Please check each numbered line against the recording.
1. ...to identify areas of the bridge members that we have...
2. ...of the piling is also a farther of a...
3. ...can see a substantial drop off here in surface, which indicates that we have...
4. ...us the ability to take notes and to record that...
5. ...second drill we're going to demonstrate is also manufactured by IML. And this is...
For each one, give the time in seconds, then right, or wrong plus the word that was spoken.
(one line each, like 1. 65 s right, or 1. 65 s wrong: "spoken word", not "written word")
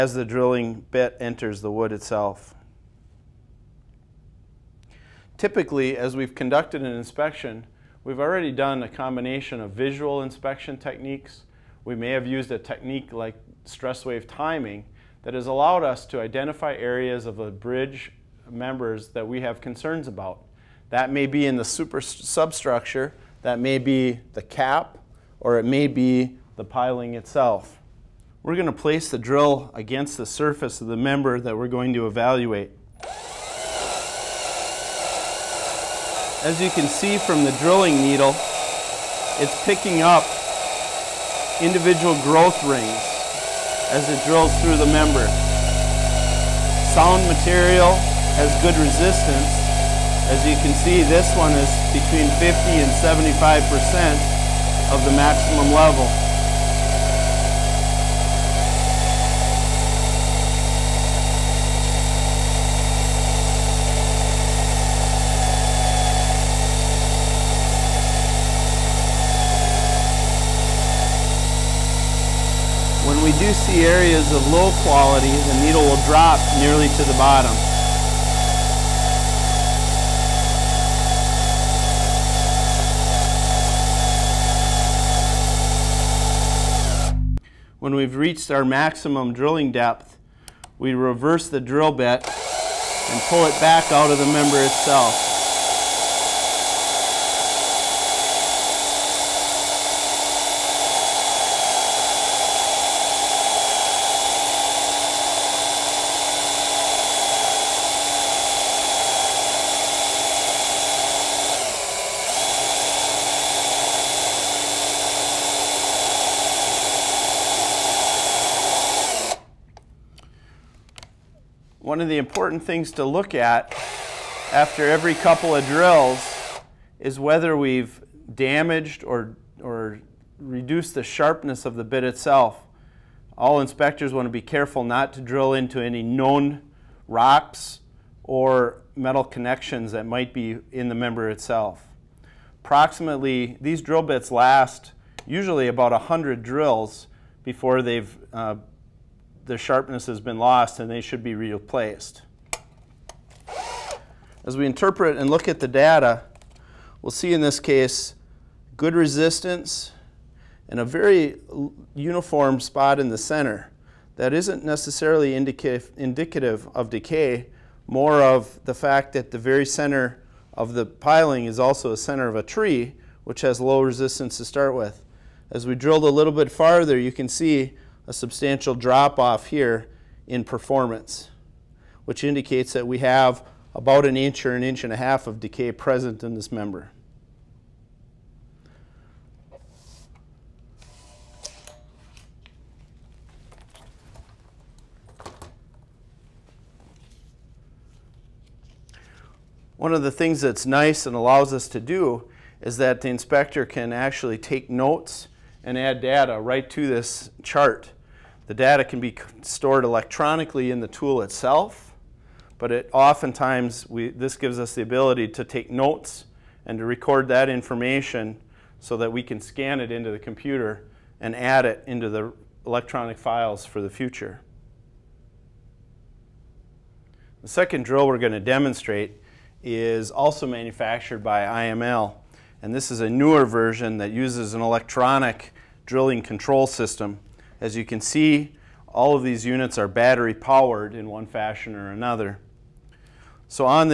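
1. 16 s right
2. 170 s wrong: "center", not "farther"
3. 177 s wrong: "performance", not "surface"
4. 214 s right
5. 227 s right.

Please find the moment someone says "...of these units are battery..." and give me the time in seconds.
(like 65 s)
239 s.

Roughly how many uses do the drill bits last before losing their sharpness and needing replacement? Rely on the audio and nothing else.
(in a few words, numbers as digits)
100.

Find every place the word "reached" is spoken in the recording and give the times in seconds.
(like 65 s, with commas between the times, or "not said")
88 s.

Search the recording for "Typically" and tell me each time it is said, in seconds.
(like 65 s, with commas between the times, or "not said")
5 s.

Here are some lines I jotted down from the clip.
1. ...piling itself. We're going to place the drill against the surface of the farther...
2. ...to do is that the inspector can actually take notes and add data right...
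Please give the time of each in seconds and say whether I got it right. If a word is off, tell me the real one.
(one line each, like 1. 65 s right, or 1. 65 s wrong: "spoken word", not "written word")
1. 26 s wrong: "member", not "farther"
2. 201 s right.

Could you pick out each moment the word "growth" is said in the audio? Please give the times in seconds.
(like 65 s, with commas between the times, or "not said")
42 s.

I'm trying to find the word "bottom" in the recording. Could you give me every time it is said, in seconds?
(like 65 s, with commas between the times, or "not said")
77 s.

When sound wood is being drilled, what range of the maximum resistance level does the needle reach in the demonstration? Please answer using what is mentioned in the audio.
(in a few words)
50 to 75%.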